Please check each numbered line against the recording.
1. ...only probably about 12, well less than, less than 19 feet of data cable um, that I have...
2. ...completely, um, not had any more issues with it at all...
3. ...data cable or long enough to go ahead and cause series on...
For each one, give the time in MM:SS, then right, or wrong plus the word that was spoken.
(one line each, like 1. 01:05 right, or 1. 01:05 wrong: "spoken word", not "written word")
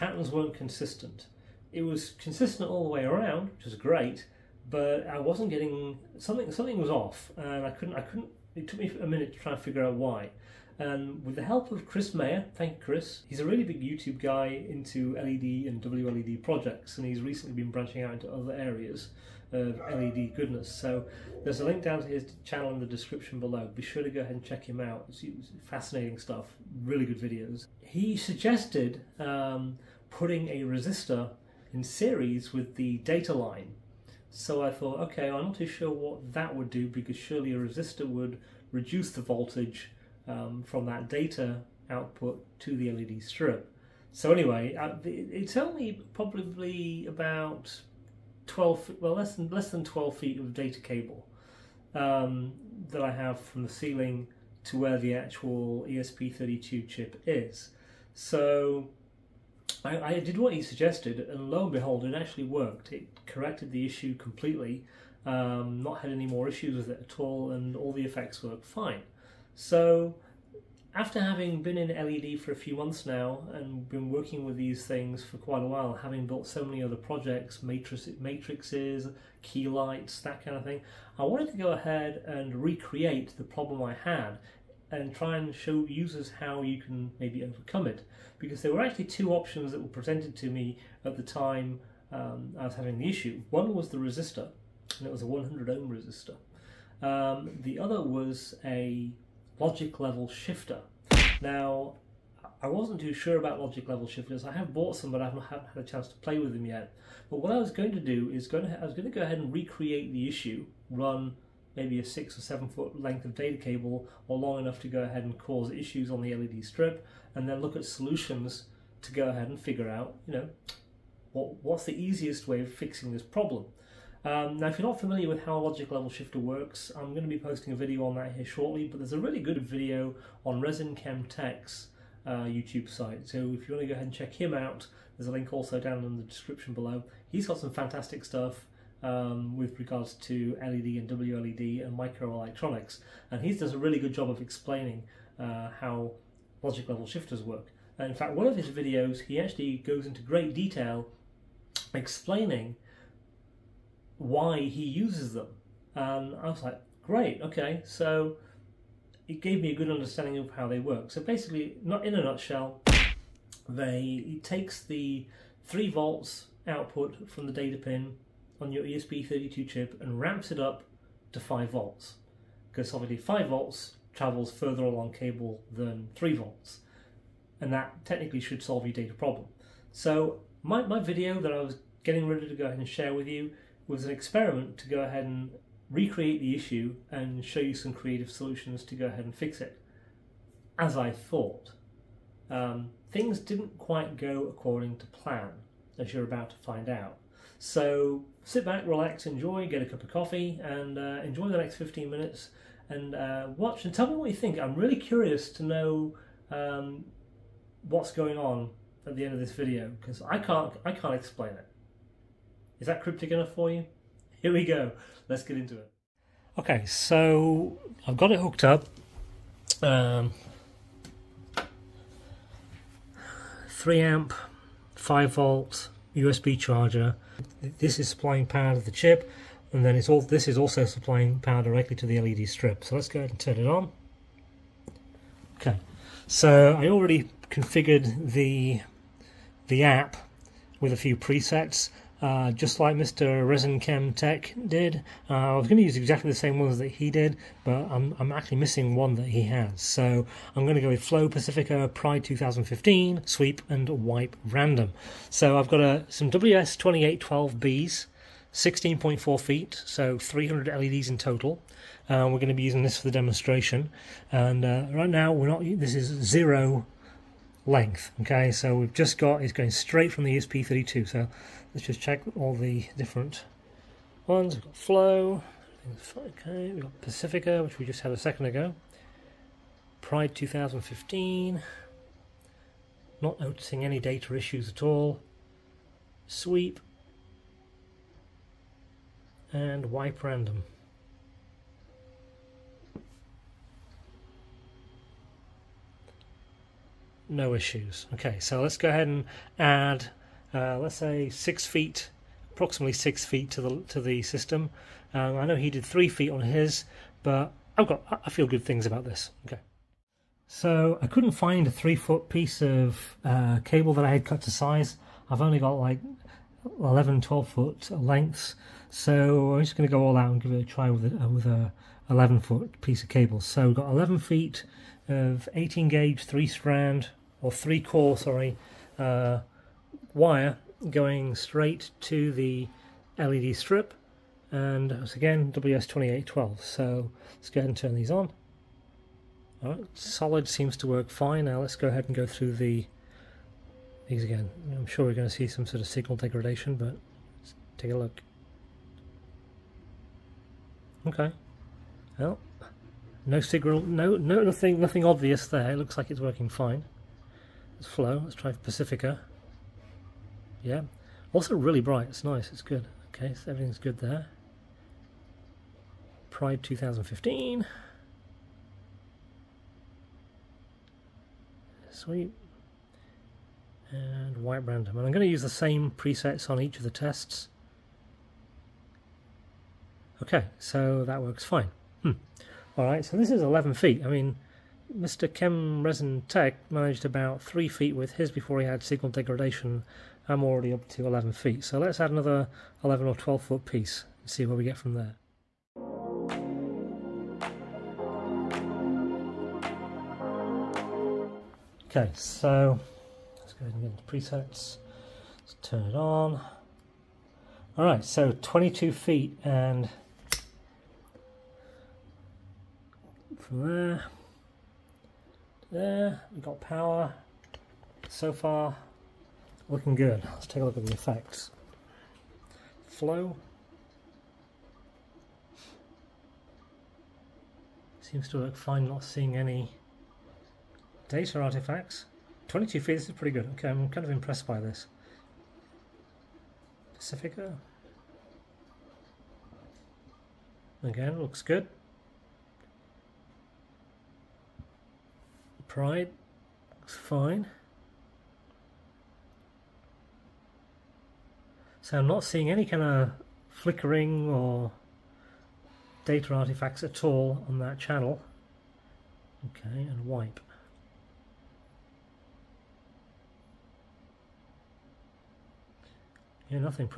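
1. 00:45 wrong: "12", not "19"
2. 01:04 right
3. 01:53 wrong: "issues", not "series".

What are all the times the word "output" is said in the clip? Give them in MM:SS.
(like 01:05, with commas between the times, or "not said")
00:41, 02:46.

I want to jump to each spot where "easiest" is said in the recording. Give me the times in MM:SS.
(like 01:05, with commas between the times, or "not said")
02:01.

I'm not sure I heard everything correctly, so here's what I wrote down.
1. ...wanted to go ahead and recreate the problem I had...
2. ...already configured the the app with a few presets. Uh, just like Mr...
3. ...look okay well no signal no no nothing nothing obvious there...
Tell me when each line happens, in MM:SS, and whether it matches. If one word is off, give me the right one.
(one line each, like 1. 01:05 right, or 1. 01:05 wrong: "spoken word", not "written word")
1. 01:21 right
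2. 03:56 right
3. 05:47 right.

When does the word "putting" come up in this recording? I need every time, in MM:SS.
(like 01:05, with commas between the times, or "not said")
00:30.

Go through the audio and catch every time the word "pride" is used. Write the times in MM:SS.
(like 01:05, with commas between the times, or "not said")
04:11, 04:40, 06:06, 07:25.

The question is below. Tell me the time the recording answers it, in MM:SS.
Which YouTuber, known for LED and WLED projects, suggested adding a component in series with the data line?
00:11.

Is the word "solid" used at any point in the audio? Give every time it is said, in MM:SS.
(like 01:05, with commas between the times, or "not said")
05:39.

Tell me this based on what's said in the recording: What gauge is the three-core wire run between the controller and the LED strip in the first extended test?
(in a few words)
18 gauge.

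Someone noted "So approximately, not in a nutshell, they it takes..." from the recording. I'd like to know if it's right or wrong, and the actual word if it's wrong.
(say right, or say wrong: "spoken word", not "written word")
wrong: "basically", not "approximately".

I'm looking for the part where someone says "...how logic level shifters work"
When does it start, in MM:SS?
02:25.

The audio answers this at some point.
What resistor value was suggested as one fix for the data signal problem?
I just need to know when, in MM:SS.
01:35.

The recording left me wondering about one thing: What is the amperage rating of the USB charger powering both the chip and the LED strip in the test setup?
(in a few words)
3 amp.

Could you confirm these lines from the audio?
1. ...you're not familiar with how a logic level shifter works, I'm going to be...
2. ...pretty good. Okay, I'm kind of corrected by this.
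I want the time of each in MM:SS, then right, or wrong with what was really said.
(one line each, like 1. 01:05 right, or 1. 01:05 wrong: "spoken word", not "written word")
1. 02:04 right
2. 07:13 wrong: "impressed", not "corrected".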